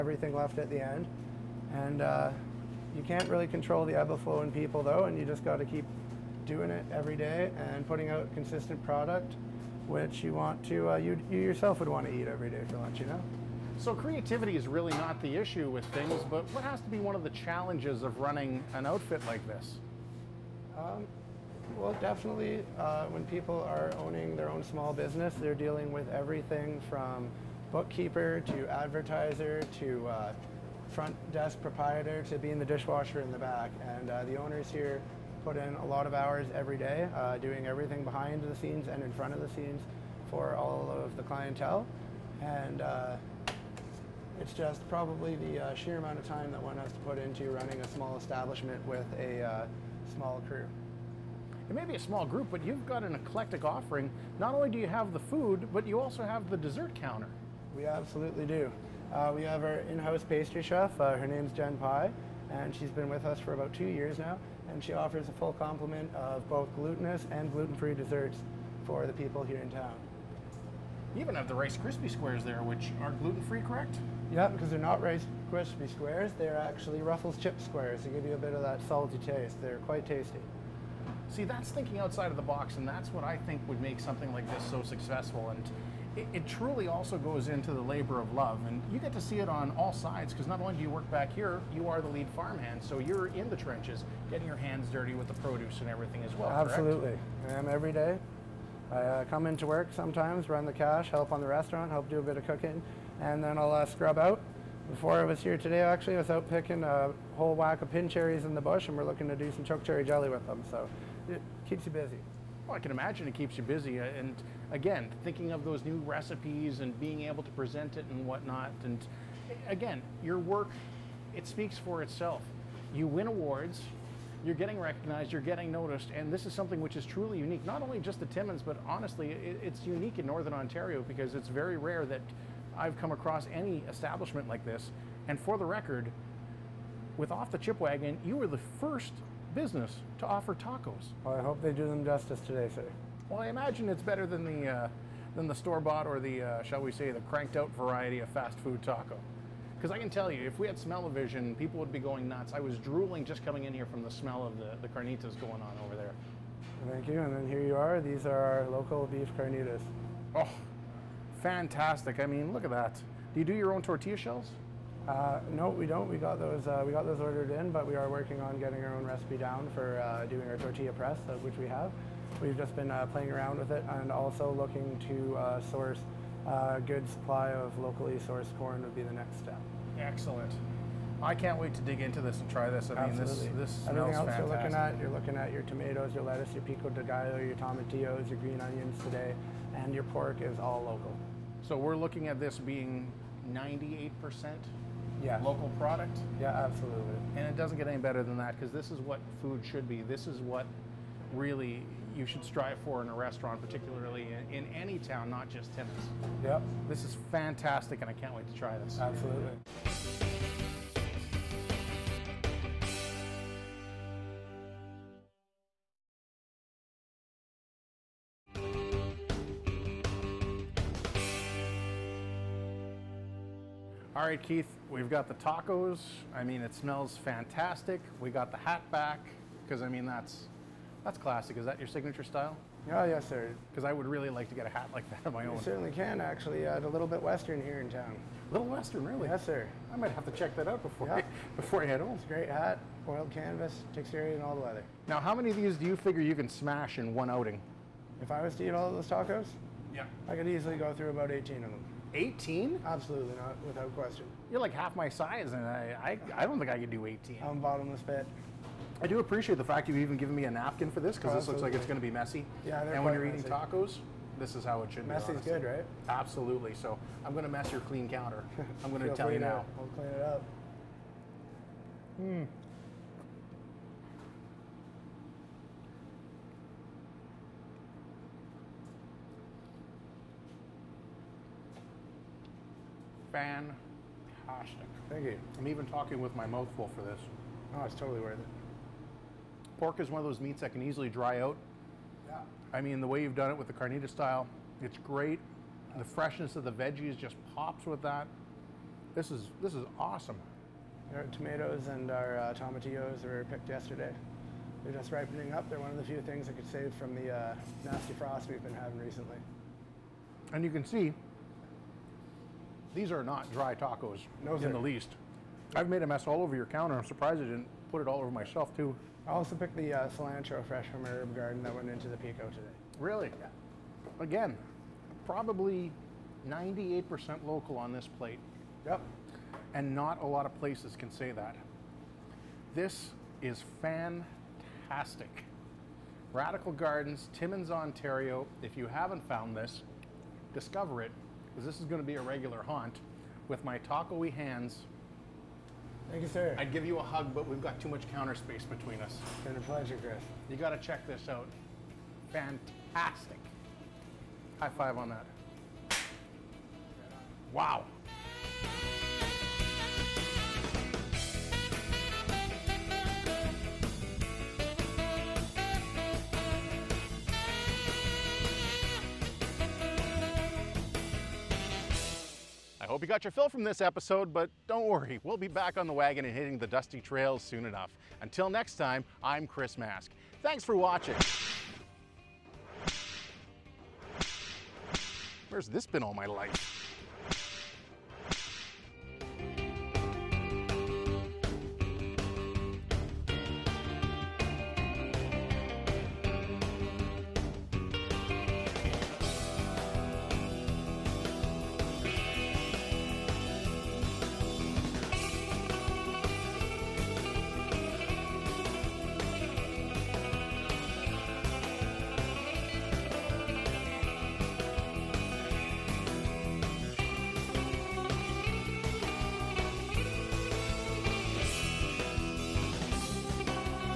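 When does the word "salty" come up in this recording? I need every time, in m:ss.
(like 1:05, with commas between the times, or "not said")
1:18.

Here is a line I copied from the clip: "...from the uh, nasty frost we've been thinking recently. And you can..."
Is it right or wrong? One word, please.
wrong.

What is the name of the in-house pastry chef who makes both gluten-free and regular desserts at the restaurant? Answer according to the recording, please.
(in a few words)
Jen Pye.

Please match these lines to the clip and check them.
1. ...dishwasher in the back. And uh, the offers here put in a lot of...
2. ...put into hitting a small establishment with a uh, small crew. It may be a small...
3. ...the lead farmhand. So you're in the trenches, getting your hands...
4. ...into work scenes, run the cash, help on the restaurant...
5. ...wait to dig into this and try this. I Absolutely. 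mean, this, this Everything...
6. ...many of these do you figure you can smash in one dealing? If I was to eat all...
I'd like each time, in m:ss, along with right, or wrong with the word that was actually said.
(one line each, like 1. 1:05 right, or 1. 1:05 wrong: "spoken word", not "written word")
1. 0:32 wrong: "owners", not "offers"
2. 0:46 wrong: "running", not "hitting"
3. 1:32 right
4. 1:39 wrong: "sometimes", not "scenes"
5. 3:01 right
6. 4:05 wrong: "outing", not "dealing".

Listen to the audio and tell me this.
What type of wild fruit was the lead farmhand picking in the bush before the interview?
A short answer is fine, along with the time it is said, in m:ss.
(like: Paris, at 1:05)
pin cherries, at 1:47.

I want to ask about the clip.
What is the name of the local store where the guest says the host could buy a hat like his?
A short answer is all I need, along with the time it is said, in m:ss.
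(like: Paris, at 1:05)
Little Bit Western, at 3:56.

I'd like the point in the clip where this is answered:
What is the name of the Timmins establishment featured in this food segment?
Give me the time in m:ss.
5:36.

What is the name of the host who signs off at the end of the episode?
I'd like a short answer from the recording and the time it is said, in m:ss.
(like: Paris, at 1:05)
Chris Mask, at 6:19.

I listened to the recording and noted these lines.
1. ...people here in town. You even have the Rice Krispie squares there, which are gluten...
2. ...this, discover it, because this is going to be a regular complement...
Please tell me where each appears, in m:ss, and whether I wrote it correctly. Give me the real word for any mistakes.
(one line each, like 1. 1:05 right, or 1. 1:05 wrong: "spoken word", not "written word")
1. 1:09 right
2. 5:39 wrong: "haunt", not "complement".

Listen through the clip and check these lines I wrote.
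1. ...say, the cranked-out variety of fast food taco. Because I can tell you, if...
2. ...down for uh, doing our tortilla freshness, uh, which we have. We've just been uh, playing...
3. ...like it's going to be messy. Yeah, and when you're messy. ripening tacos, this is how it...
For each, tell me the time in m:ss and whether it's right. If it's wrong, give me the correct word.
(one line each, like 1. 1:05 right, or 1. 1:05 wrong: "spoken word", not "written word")
1. 2:26 right
2. 2:49 wrong: "press", not "freshness"
3. 4:21 wrong: "eating", not "ripening".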